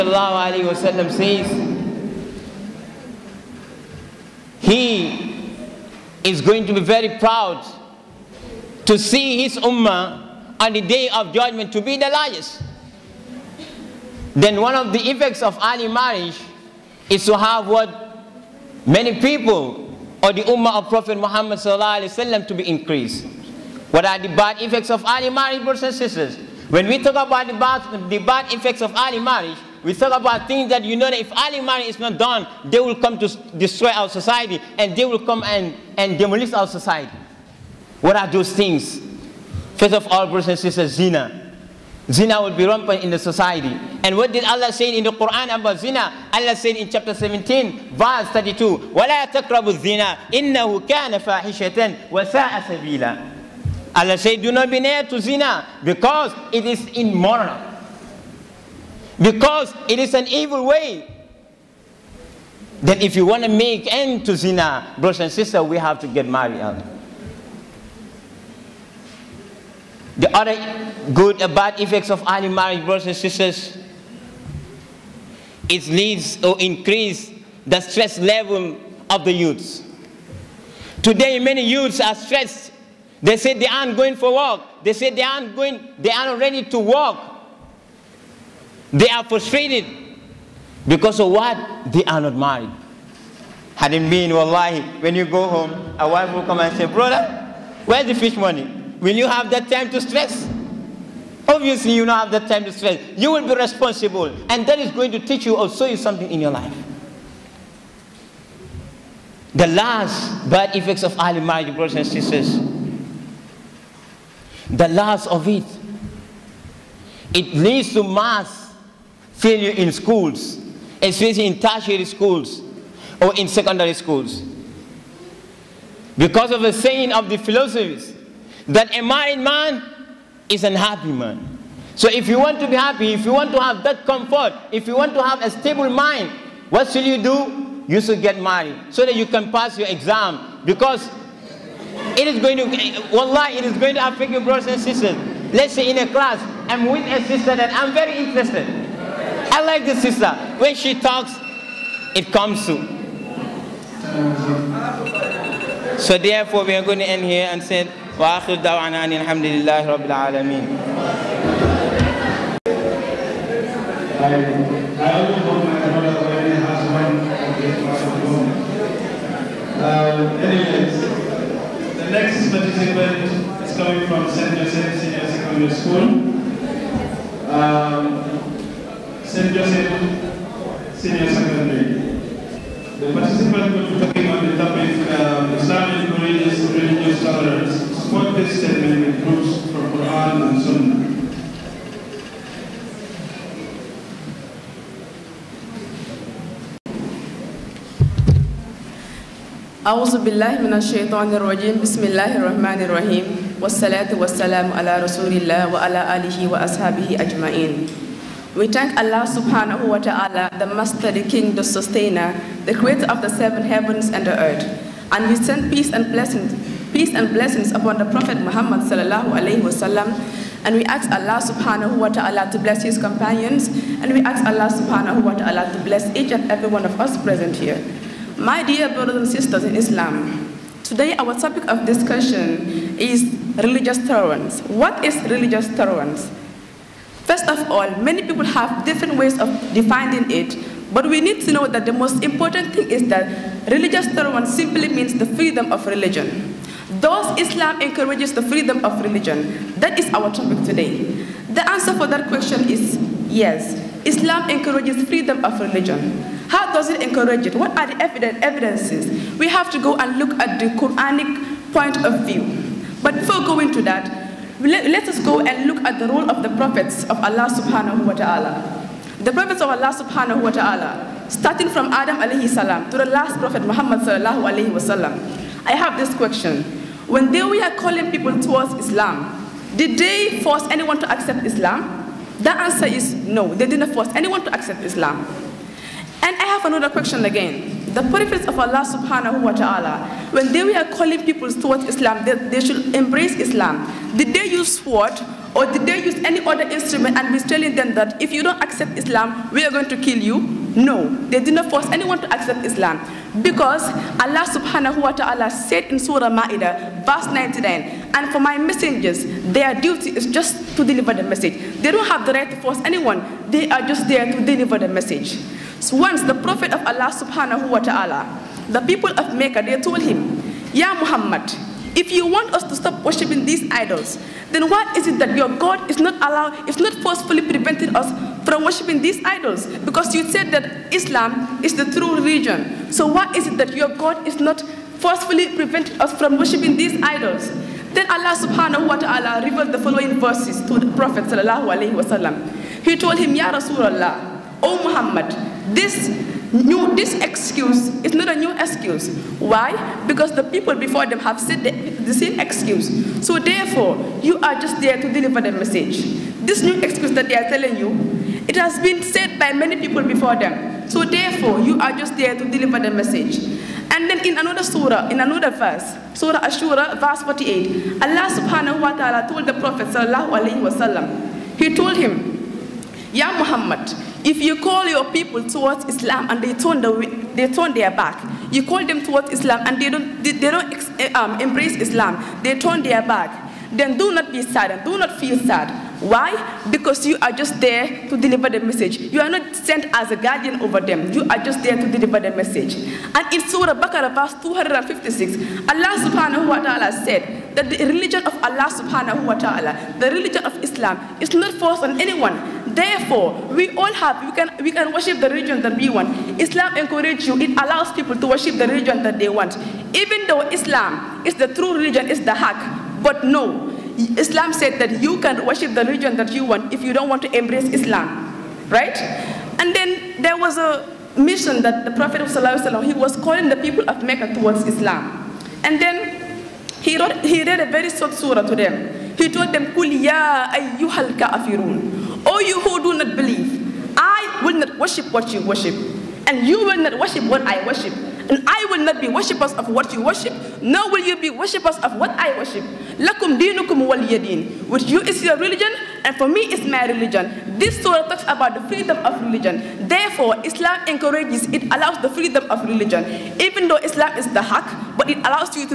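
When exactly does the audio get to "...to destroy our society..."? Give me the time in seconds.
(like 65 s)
33 s.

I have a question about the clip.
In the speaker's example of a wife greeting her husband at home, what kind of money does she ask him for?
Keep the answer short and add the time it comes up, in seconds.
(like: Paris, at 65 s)
Fish money, at 98 s.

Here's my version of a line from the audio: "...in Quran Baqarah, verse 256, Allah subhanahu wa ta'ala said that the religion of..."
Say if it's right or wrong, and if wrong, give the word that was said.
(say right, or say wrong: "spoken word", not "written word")
wrong: "Surah", not "Quran".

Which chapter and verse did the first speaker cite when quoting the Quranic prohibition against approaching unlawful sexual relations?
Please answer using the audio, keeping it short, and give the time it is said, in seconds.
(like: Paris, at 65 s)
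Chapter 17, verse 32, at 46 s.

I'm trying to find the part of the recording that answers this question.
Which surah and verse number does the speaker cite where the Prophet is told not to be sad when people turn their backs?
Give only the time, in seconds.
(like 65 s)
366 s.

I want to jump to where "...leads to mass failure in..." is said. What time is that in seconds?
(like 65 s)
117 s.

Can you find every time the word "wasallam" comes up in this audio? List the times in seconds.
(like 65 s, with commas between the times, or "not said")
219 s, 341 s, 370 s.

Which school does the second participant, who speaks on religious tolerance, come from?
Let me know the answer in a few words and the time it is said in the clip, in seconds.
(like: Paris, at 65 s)
St. Joseph Senior Secondary School, at 174 s.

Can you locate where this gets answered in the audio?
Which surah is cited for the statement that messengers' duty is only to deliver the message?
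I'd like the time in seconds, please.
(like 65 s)
305 s.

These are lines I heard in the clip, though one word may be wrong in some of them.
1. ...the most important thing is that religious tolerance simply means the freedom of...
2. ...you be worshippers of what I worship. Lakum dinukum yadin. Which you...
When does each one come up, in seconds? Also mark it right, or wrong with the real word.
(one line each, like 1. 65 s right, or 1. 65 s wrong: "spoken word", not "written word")
1. 241 s right
2. 441 s right.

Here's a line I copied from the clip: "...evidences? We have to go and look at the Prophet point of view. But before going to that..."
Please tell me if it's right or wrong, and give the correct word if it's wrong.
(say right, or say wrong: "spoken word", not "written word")
wrong: "Quranic", not "Prophet".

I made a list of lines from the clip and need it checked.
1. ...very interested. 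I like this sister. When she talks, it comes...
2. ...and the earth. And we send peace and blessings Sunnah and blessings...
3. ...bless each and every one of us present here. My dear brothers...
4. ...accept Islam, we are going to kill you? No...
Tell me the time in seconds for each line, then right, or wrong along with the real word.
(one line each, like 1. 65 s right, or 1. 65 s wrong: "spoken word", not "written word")
1. 147 s right
2. 214 s wrong: "Peace", not "Sunnah"
3. 225 s right
4. 298 s right.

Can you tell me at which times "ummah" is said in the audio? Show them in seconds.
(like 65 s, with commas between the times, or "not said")
9 s, 20 s.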